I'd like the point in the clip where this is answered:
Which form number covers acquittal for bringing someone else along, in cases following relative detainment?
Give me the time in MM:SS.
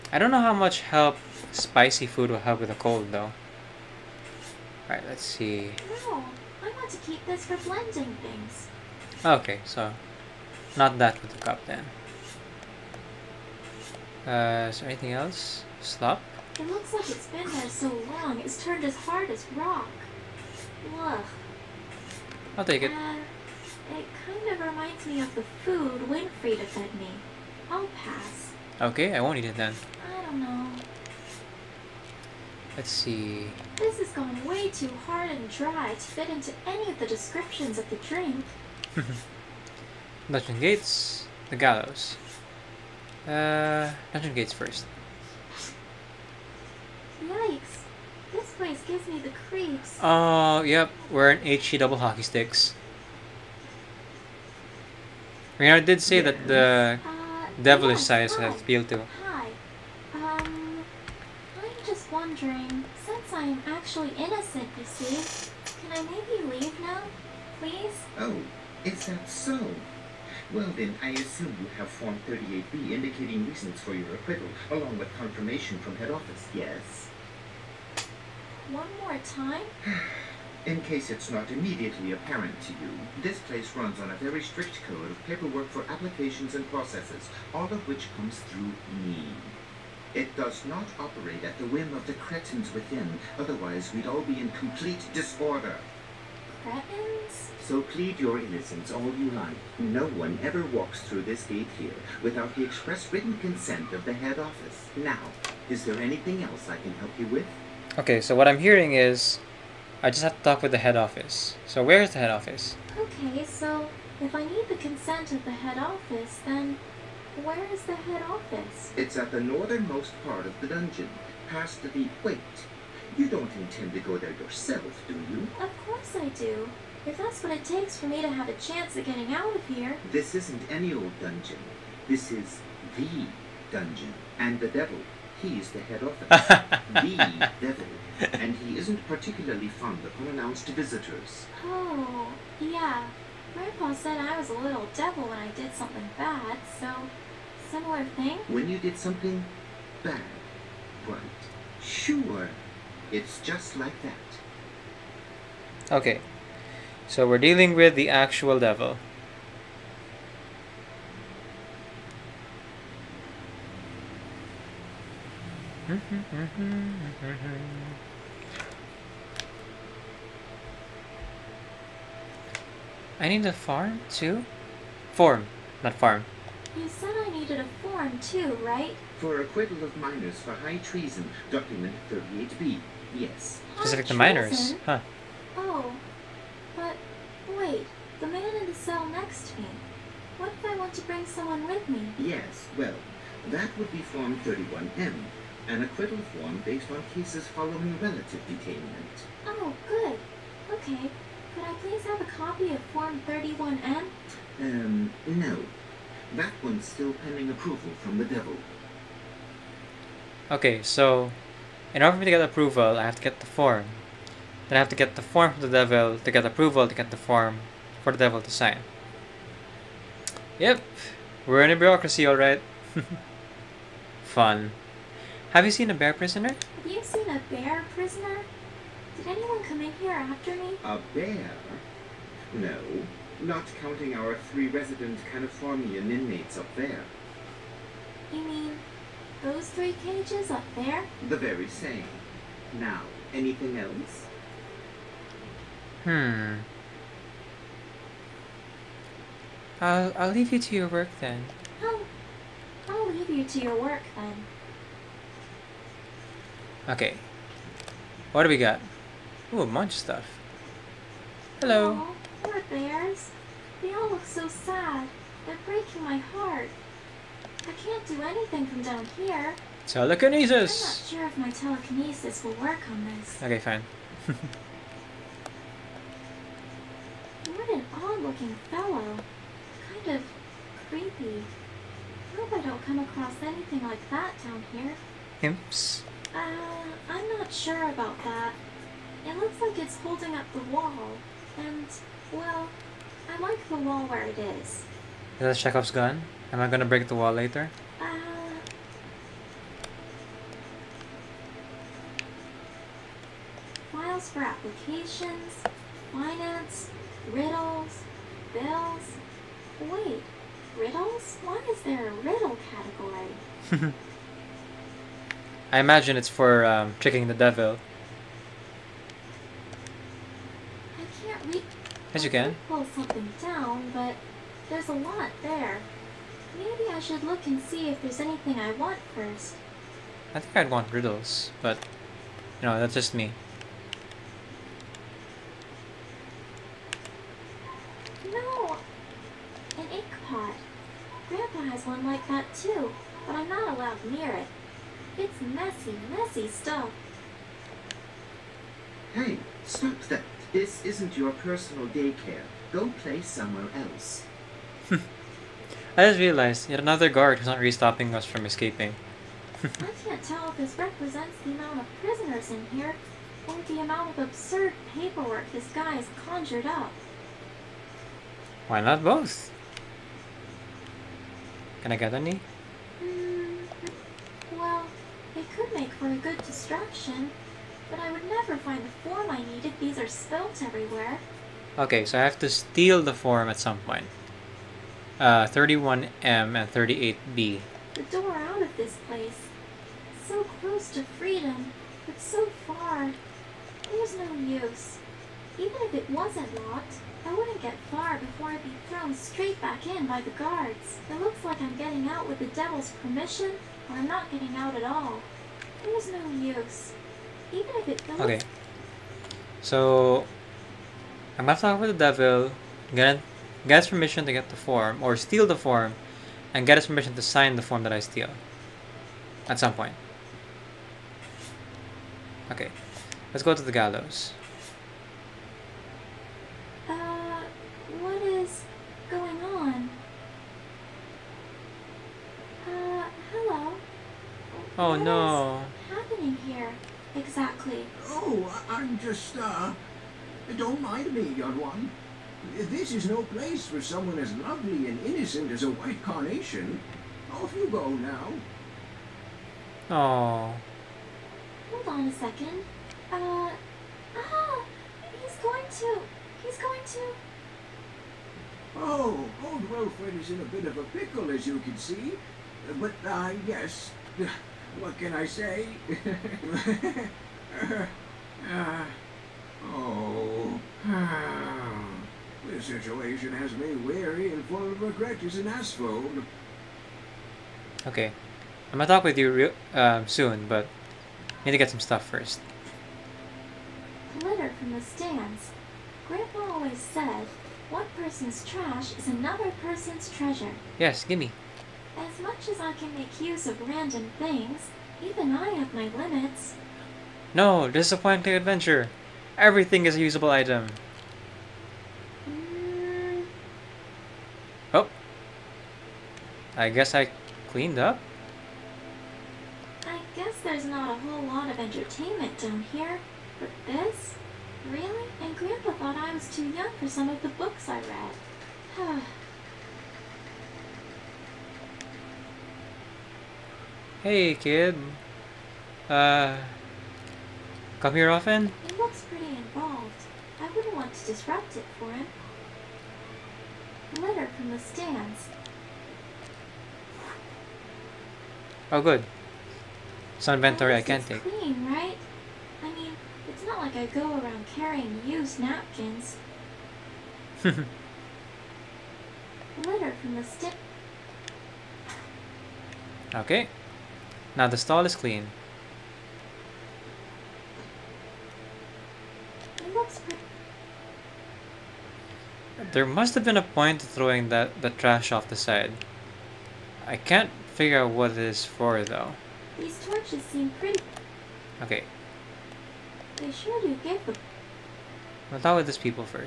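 03:13.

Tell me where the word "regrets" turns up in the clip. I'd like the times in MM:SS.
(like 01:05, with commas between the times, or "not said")
07:54.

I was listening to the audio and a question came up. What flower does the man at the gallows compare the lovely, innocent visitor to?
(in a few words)
White carnation.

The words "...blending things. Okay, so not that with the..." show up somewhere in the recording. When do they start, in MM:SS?
00:07.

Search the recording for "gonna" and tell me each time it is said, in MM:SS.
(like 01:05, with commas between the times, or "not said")
04:56, 06:51, 07:58.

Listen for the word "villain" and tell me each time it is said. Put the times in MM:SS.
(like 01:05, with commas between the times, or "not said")
not said.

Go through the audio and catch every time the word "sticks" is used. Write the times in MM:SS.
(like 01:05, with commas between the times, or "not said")
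00:52, 09:10.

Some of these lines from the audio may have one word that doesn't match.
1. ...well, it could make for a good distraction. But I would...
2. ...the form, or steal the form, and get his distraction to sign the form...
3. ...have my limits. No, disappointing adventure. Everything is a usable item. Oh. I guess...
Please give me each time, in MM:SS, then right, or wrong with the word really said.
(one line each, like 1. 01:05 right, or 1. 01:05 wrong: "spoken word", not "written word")
1. 06:14 right
2. 06:54 wrong: "permission", not "distraction"
3. 08:15 right.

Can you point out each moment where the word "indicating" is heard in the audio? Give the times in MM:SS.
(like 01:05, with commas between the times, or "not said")
01:12.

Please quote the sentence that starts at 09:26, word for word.
I can't figure out what it is for though.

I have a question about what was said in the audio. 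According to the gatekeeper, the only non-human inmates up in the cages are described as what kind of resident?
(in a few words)
Californian.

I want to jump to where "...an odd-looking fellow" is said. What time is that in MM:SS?
04:37.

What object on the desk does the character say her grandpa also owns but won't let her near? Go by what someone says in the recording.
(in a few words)
An ink pot.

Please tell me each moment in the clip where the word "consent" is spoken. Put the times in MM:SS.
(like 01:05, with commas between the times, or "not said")
01:43, 01:54.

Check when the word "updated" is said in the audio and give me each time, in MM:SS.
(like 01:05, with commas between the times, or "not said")
not said.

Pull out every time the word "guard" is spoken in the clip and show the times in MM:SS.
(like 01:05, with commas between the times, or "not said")
05:57, 06:40.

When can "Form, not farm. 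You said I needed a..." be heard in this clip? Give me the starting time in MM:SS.
02:55.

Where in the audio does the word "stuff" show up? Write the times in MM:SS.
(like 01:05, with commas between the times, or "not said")
04:19, 05:46, 08:01.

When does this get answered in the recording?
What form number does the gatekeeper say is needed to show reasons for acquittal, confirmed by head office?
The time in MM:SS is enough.
01:11.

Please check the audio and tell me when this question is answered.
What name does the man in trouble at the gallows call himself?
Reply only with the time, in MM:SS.
07:39.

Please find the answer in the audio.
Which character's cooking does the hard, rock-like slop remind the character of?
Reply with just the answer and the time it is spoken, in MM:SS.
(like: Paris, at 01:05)
Winfrieda, at 00:26.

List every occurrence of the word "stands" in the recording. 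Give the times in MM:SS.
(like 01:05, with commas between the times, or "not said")
08:04, 08:54.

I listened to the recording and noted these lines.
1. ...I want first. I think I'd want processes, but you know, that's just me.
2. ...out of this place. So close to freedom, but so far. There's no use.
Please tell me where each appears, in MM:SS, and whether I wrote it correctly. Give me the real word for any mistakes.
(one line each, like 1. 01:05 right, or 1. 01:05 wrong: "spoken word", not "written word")
1. 05:28 wrong: "riddles", not "processes"
2. 06:28 right.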